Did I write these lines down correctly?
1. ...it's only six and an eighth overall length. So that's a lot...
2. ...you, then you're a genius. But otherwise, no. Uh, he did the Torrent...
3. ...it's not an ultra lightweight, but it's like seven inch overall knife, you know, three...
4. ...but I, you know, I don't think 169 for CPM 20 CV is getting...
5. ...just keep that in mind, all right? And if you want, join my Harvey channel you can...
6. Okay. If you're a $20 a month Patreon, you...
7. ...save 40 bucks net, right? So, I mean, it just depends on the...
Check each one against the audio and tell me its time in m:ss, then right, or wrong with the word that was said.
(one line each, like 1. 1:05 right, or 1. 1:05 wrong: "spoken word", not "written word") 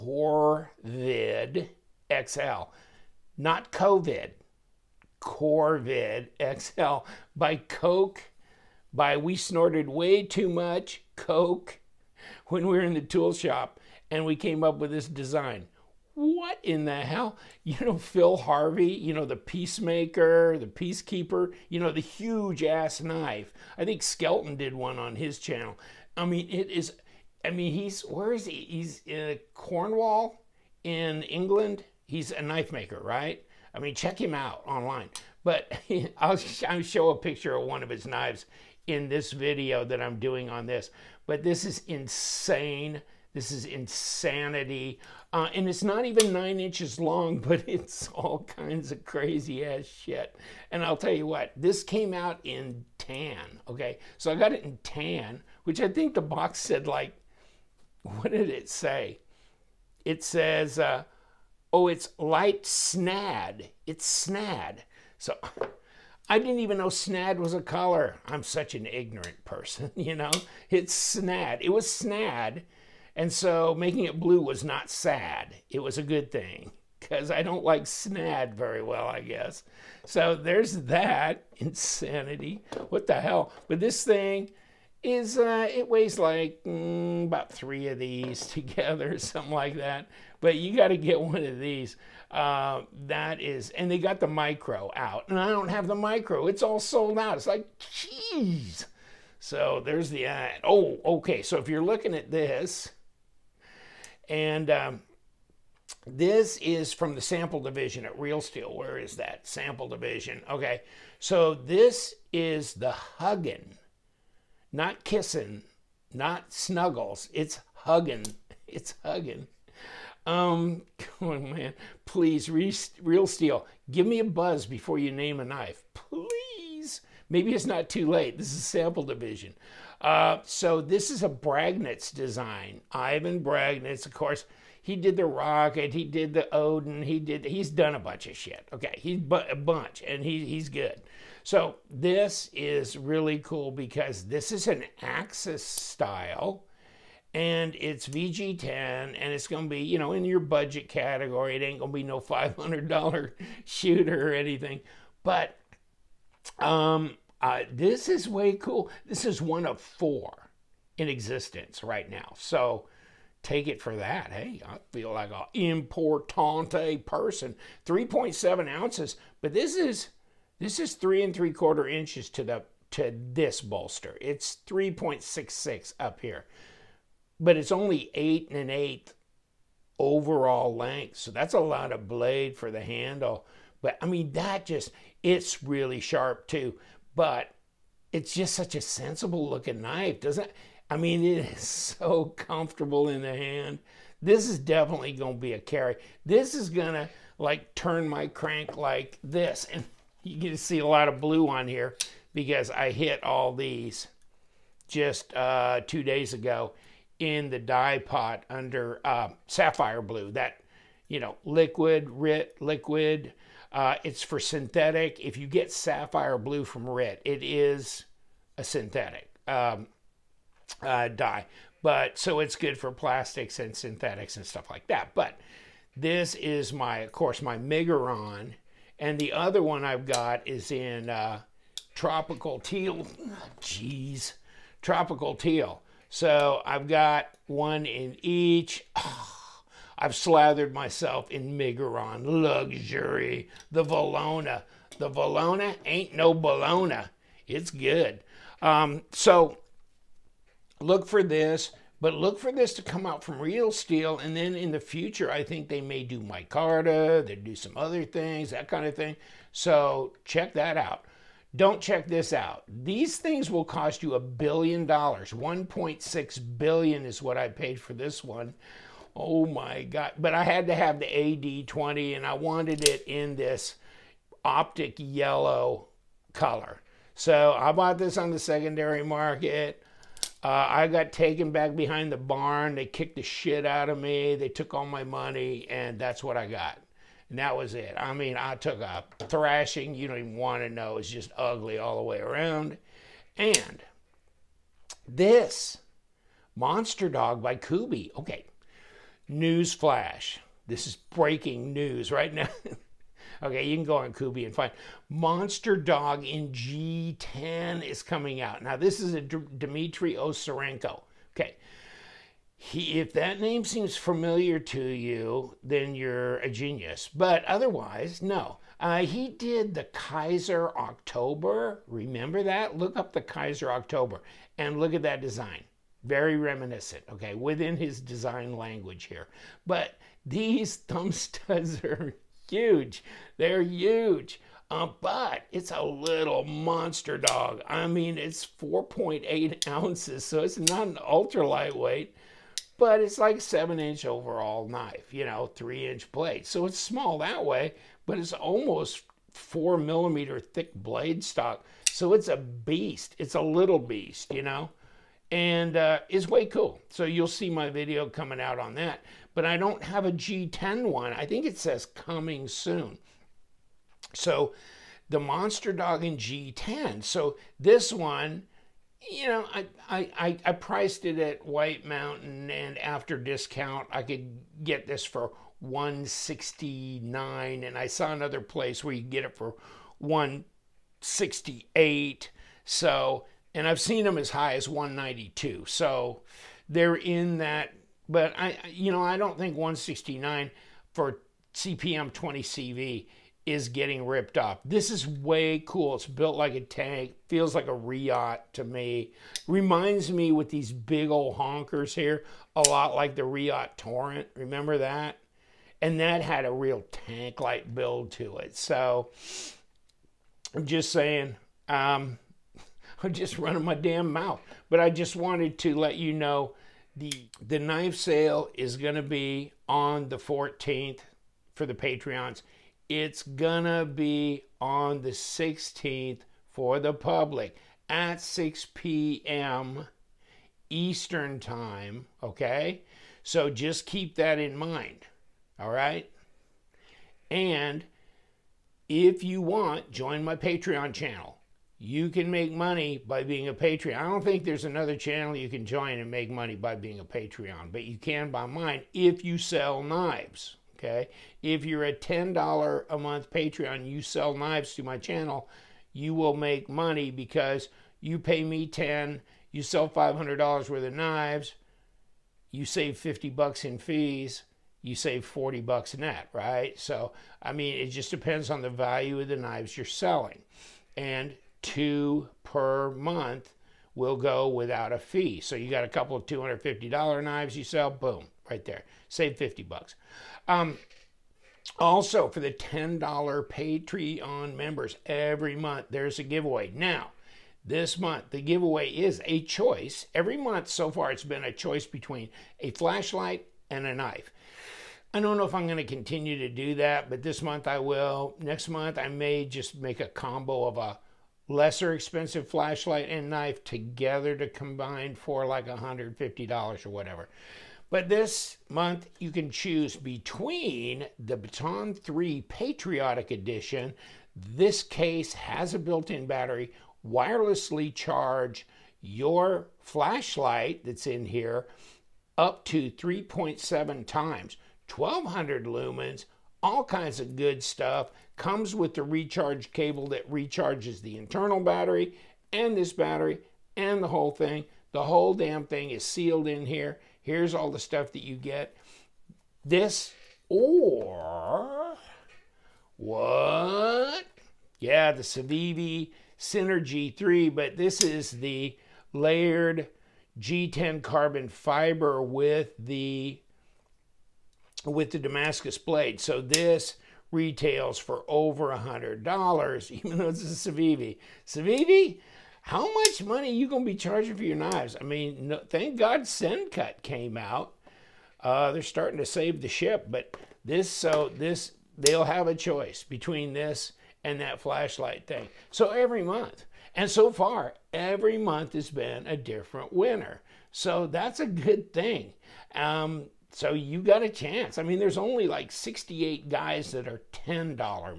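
1. 2:57 wrong: "eight", not "six"
2. 5:14 wrong: "Kizer", not "Torrent"
3. 5:40 right
4. 6:28 right
5. 7:13 wrong: "Patreon", not "Harvey"
6. 7:30 wrong: "10", not "20"
7. 7:44 right.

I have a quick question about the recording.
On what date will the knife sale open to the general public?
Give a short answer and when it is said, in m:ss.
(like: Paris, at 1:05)
the 16th, at 7:05.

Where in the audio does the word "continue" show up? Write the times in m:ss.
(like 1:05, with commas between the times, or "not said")
8:15.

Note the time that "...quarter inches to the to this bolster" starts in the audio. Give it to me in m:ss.
2:51.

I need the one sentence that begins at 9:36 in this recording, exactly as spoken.
And so far, every month has been a different winner.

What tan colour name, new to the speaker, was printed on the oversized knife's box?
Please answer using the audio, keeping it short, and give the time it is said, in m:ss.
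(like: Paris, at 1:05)
light snad, at 1:02.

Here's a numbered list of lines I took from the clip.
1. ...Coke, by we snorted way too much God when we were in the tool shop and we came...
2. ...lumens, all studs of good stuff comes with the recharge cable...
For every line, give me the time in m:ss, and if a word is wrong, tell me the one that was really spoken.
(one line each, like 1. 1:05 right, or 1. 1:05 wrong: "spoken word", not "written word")
1. 0:07 wrong: "Coke", not "God"
2. 8:45 wrong: "kinds", not "studs".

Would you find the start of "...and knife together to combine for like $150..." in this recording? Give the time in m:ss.
8:23.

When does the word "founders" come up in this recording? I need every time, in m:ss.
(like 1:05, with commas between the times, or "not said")
not said.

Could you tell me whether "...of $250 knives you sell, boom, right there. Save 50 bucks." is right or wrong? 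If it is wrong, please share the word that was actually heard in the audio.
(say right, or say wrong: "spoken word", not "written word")
right.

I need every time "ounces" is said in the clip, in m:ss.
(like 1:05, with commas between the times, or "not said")
2:48, 5:39.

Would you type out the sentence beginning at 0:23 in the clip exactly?
I think Skelton did one on his channel.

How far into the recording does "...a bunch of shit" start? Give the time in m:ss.
2:17.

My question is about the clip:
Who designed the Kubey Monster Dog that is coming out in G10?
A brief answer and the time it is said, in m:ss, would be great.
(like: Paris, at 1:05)
Dmitry Osarenko, at 5:09.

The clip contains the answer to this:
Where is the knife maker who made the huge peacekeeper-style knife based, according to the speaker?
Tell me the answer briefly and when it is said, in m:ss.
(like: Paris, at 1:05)
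Cornwall, at 0:29.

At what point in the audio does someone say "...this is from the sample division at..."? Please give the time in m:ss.
1:46.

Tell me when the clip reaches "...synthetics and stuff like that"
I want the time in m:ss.
3:43.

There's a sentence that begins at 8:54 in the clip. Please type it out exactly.
The whole damn thing is sealed in here.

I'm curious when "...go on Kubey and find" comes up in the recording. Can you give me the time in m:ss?
5:03.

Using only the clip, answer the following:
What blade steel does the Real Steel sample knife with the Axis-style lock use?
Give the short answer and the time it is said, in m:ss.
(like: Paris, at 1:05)
VG10, at 2:28.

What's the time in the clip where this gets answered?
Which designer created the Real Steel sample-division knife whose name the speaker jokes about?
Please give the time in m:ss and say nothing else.
2:12.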